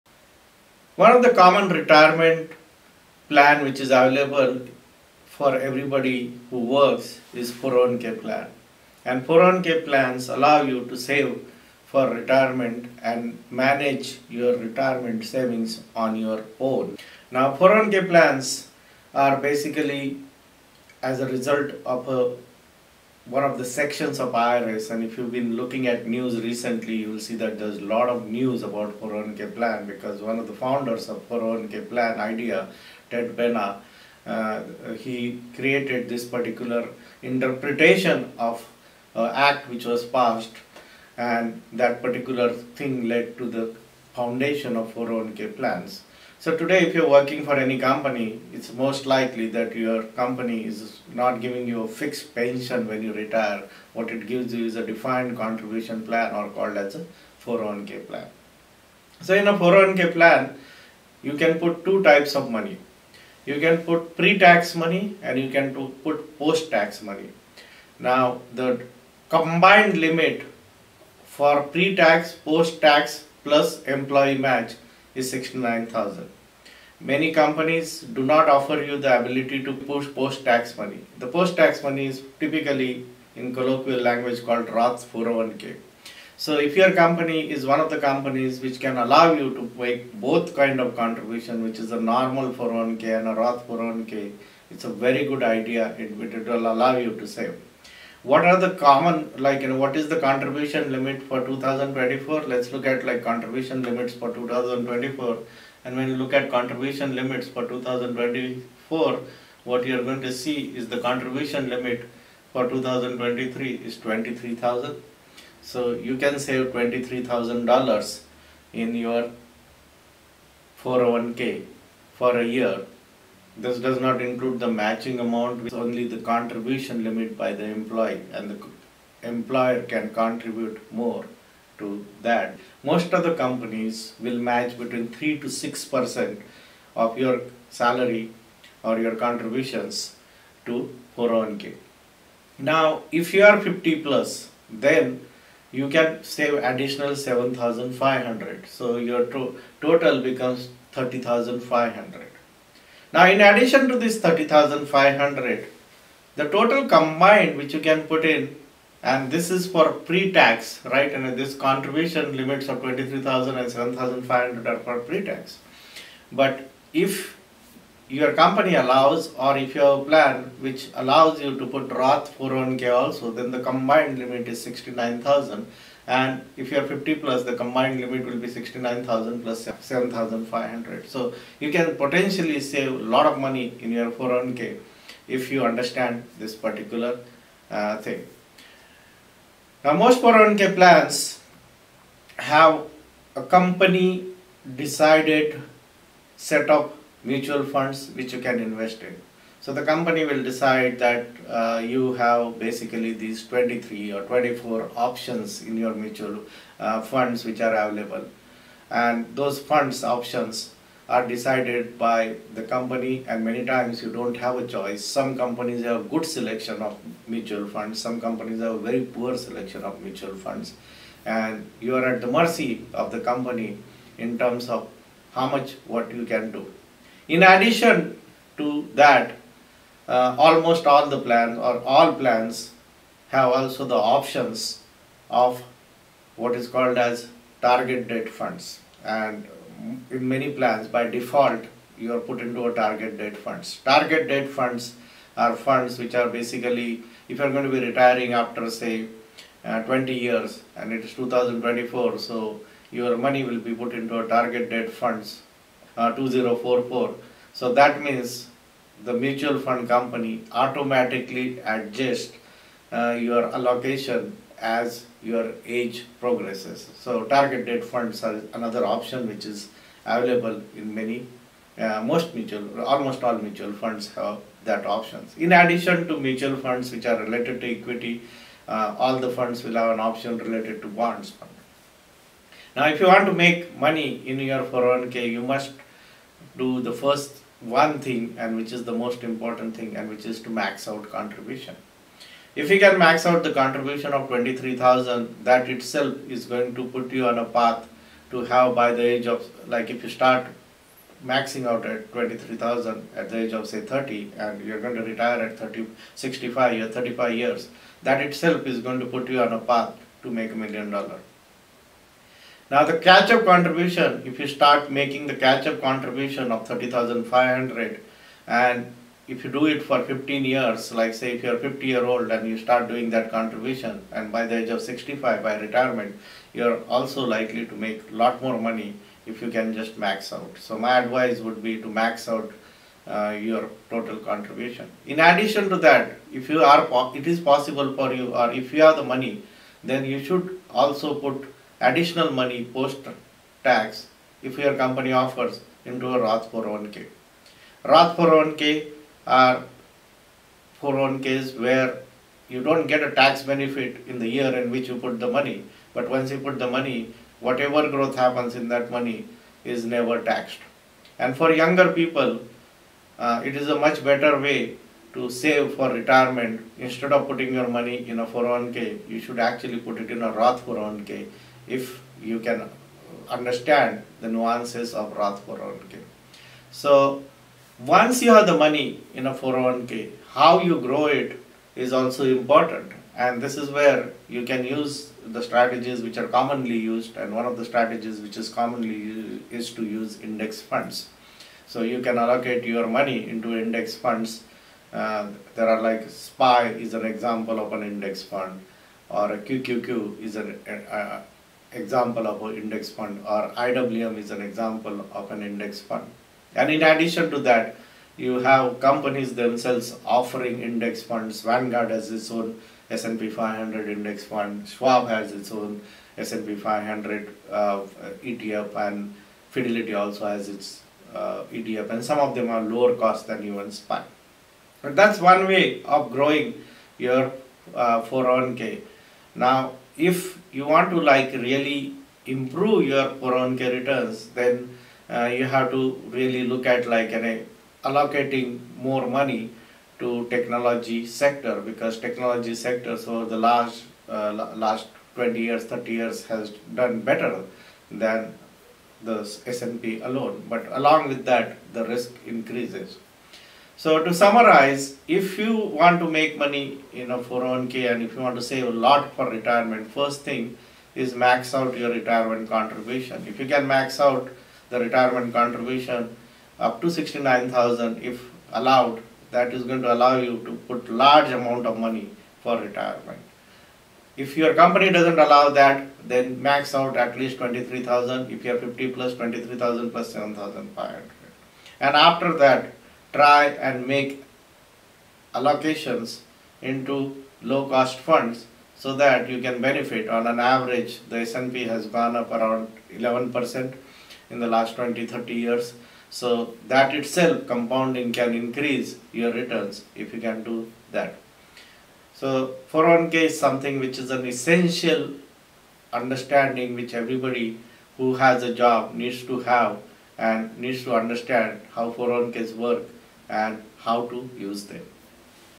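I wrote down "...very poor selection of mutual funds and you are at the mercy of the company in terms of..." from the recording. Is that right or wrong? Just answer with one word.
right.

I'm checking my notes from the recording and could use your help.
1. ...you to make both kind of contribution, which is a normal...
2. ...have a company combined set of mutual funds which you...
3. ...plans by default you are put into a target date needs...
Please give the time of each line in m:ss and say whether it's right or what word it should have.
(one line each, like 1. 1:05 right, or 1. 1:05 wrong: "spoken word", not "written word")
1. 1:29 right
2. 3:12 wrong: "decided", not "combined"
3. 4:00 wrong: "funds", not "needs".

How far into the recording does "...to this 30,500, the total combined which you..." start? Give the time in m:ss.
2:33.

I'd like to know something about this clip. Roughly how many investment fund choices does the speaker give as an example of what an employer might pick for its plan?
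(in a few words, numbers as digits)
23 or 24.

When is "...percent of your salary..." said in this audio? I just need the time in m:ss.
2:15.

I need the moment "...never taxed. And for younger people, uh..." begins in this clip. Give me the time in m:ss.
5:59.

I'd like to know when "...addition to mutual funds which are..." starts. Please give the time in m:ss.
4:35.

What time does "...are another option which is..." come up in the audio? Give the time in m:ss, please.
4:28.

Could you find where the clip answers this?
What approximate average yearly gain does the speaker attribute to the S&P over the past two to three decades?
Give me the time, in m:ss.
8:12.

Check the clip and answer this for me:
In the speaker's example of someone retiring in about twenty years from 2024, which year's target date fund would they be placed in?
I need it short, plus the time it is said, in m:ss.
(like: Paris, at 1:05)
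2044, at 4:16.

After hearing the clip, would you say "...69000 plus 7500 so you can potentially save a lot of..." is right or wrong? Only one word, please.
right.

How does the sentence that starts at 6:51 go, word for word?
Vanguard has its own S&P 500 index fund.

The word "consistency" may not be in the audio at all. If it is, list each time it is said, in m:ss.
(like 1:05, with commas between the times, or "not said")
not said.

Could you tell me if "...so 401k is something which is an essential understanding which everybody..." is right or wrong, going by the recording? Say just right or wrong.
right.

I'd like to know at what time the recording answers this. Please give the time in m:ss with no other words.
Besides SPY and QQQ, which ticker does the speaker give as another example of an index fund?
6:43.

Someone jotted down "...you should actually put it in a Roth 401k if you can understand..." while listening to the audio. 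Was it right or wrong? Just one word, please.
right.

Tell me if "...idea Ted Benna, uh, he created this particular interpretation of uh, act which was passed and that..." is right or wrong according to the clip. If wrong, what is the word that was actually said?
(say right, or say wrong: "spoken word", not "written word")
right.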